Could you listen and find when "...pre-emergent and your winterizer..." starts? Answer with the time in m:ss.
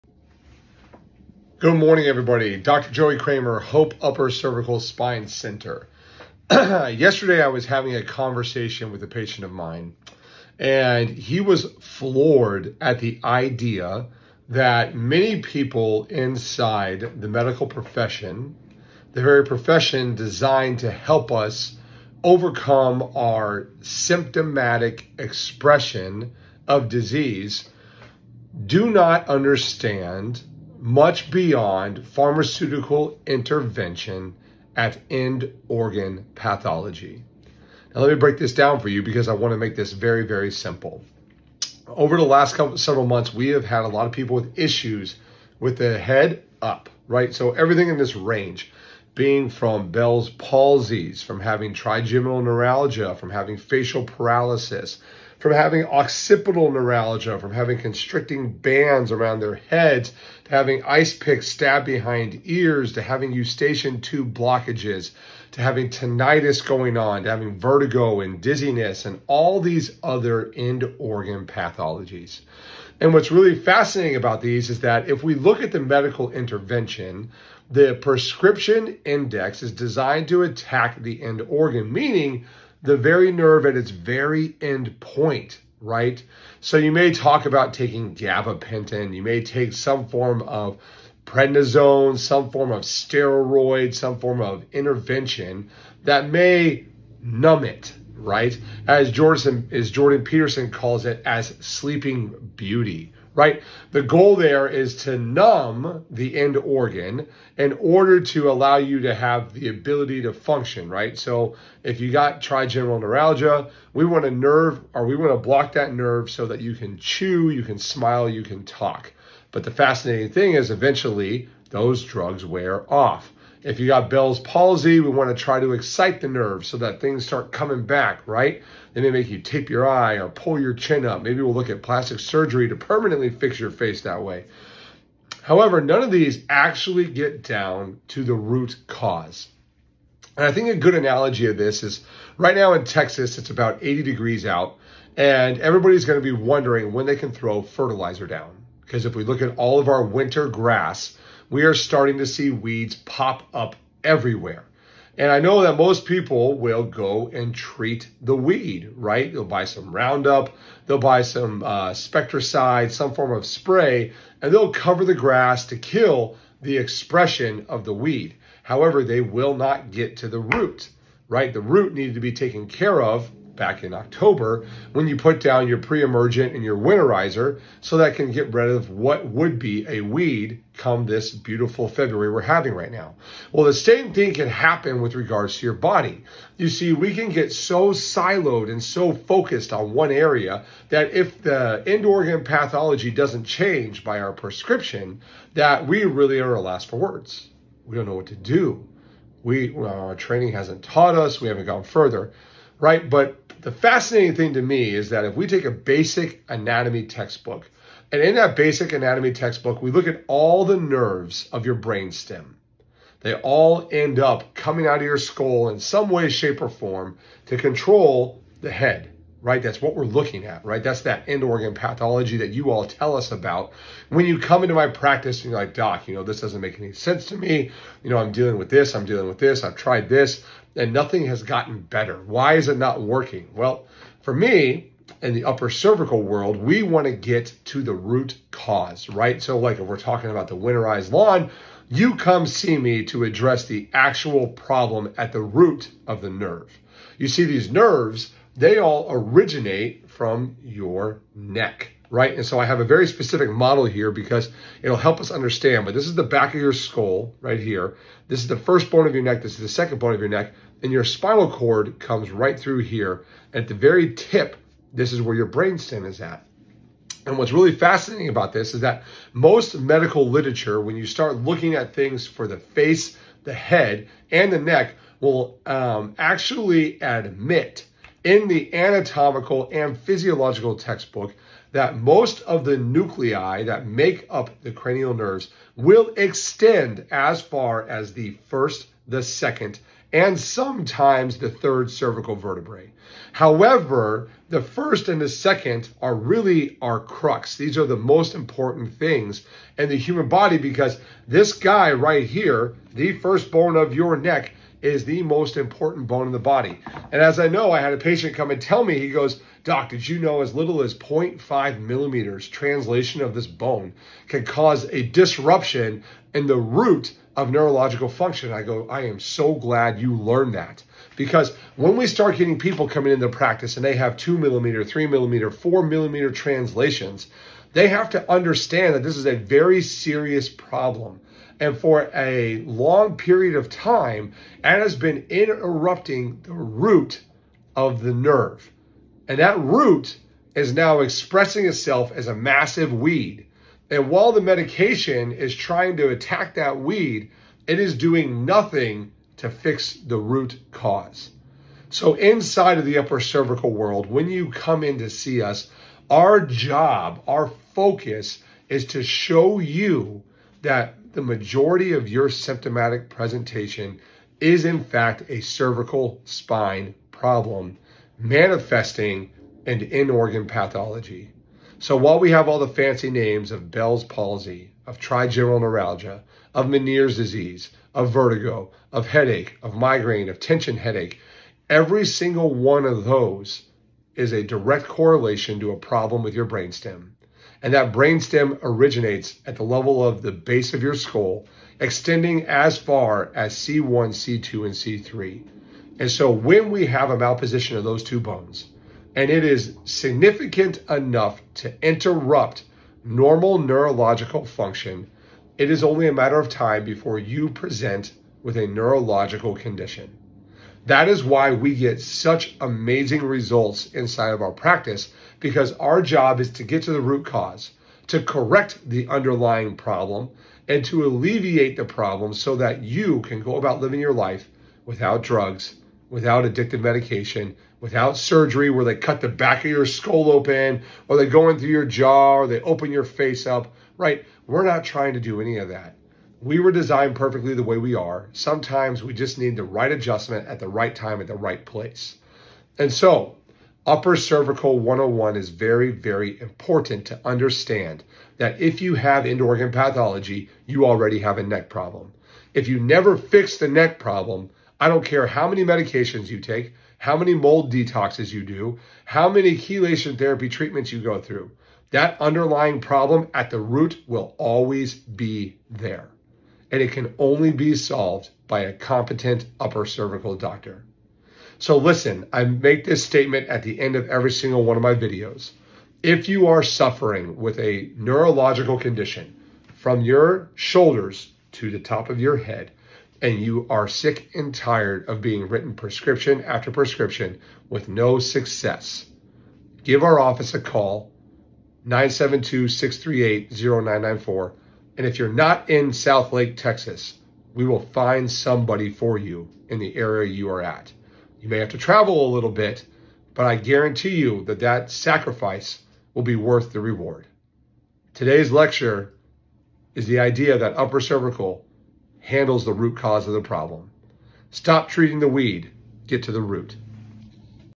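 2:55.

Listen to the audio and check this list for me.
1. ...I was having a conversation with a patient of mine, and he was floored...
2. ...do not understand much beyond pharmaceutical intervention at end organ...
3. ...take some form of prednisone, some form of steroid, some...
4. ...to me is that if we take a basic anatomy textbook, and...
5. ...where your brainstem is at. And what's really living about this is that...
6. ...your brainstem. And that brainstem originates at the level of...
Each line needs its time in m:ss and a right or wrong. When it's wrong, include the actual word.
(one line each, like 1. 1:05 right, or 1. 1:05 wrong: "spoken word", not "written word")
1. 0:07 right
2. 0:28 right
3. 1:29 right
4. 3:24 right
5. 4:25 wrong: "fascinating", not "living"
6. 6:26 right.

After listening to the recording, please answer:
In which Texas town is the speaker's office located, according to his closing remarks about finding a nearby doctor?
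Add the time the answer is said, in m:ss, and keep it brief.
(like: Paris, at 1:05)
Southlake, at 8:15.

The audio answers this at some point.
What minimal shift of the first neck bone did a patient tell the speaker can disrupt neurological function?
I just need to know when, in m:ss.
5:10.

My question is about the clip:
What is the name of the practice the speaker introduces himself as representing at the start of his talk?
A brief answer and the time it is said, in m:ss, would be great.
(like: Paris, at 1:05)
Hope Upper Cervical Spine Center, at 0:03.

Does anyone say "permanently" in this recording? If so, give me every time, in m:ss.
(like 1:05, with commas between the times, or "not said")
2:12.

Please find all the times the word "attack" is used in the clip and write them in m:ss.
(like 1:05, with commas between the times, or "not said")
1:20, 5:46.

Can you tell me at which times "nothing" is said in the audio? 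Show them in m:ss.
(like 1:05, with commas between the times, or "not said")
3:50, 5:48.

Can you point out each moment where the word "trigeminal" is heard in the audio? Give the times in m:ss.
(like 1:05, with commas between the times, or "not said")
0:51, 1:52, 6:14.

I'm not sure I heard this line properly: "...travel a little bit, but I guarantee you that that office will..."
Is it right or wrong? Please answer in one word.
wrong.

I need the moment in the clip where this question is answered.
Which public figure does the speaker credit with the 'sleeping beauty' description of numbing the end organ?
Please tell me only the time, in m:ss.
1:39.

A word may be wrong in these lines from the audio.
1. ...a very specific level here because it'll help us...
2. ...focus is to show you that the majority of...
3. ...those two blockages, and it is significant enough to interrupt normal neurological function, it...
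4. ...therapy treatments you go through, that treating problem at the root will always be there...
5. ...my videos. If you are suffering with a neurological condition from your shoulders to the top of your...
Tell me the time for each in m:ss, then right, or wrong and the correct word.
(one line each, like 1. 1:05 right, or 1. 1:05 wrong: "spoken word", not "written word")
1. 4:12 wrong: "model", not "level"
2. 5:57 right
3. 6:37 wrong: "bones", not "blockages"
4. 7:40 wrong: "underlying", not "treating"
5. 7:54 right.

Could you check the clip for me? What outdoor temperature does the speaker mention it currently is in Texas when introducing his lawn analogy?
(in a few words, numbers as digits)
80 degrees.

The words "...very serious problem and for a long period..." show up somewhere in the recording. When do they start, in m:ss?
5:29.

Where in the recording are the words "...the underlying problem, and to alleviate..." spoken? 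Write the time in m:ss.
6:58.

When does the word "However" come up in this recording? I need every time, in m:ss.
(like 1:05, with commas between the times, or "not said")
2:15, 2:48, 4:53.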